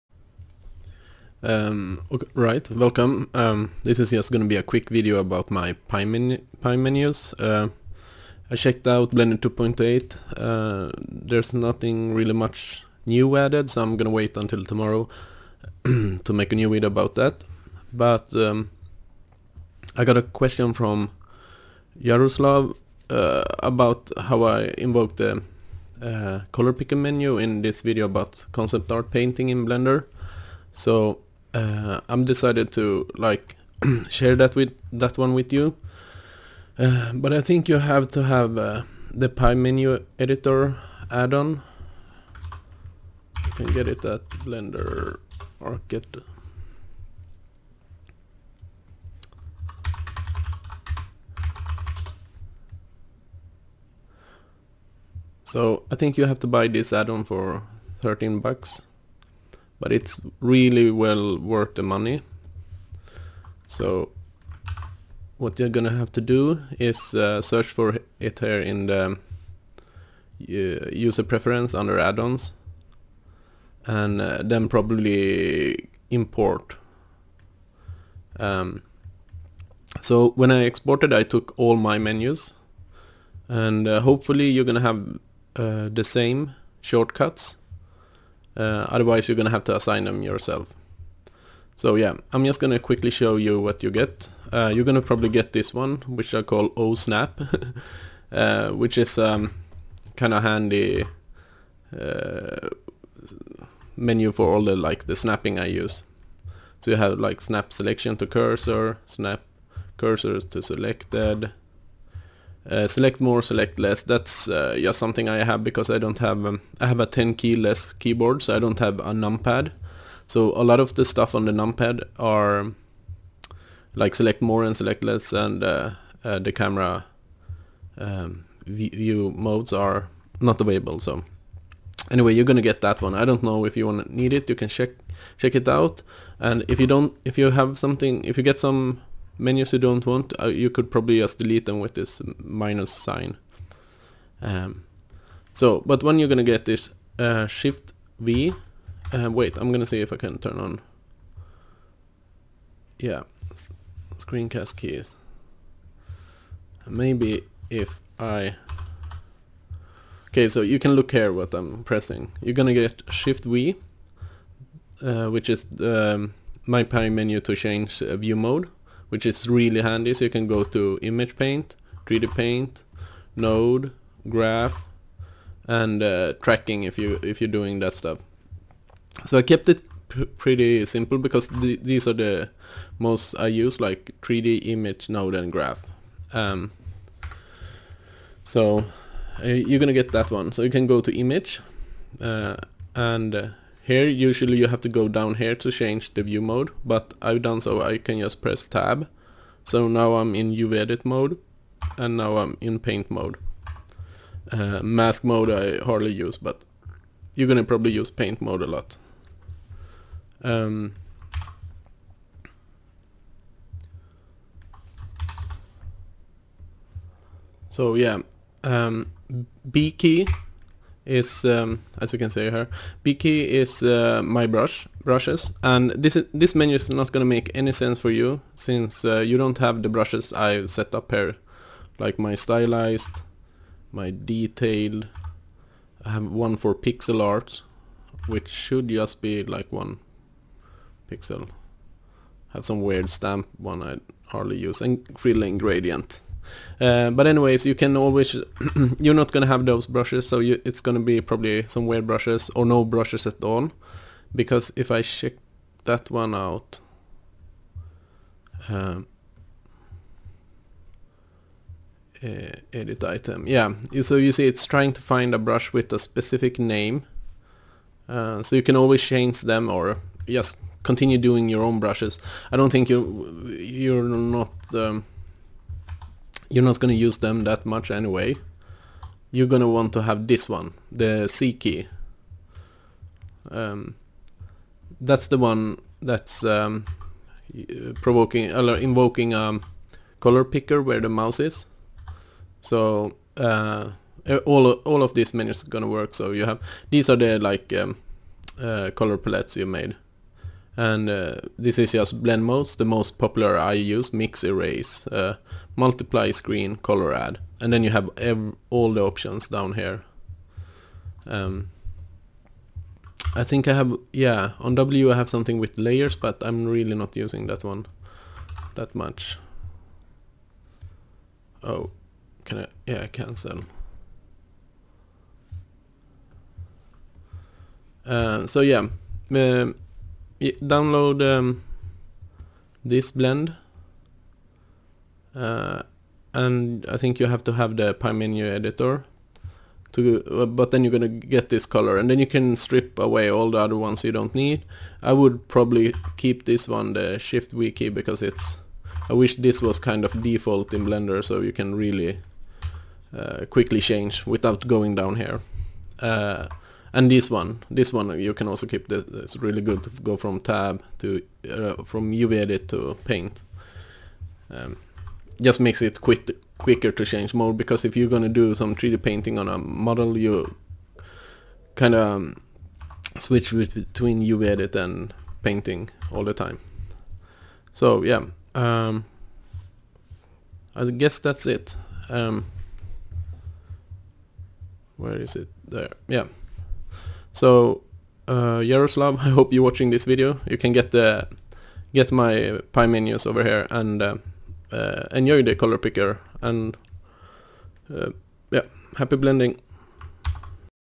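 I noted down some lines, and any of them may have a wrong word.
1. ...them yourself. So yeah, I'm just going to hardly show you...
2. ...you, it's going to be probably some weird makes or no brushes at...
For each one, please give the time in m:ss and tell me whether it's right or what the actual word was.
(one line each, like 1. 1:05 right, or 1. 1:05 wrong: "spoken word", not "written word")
1. 1:30 wrong: "quickly", not "hardly"
2. 4:10 wrong: "brushes", not "makes".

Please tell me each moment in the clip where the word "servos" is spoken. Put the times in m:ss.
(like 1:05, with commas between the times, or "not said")
not said.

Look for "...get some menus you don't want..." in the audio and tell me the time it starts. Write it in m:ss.
2:18.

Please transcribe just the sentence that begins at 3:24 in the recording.
Uh, mask mode I hardly use, but you're gonna probably use paint mode a lot.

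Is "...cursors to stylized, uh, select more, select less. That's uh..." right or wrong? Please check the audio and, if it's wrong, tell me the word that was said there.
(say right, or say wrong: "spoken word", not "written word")
wrong: "selected", not "stylized".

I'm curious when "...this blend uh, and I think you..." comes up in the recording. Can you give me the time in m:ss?
5:32.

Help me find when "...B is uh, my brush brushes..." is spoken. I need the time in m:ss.
3:43.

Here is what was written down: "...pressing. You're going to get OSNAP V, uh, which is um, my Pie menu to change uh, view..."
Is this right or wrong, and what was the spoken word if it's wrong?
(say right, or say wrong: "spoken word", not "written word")
wrong: "Shift", not "OSNAP".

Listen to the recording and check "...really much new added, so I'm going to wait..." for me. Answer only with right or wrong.
right.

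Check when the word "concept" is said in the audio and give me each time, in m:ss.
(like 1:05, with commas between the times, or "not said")
0:28.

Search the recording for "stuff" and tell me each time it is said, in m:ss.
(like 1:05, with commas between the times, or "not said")
2:01, 2:57.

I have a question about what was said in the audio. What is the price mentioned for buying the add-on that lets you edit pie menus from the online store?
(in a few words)
13 bucks.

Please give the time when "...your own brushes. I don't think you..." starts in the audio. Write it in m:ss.
4:31.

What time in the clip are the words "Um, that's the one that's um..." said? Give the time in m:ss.
4:43.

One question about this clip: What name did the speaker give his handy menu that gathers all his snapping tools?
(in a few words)
OSNAP.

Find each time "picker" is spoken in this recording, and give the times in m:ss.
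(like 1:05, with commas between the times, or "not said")
0:26, 4:50, 6:35.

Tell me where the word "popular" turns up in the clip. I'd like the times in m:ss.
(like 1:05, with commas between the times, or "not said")
5:03.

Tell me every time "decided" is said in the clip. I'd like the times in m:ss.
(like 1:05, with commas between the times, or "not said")
0:32.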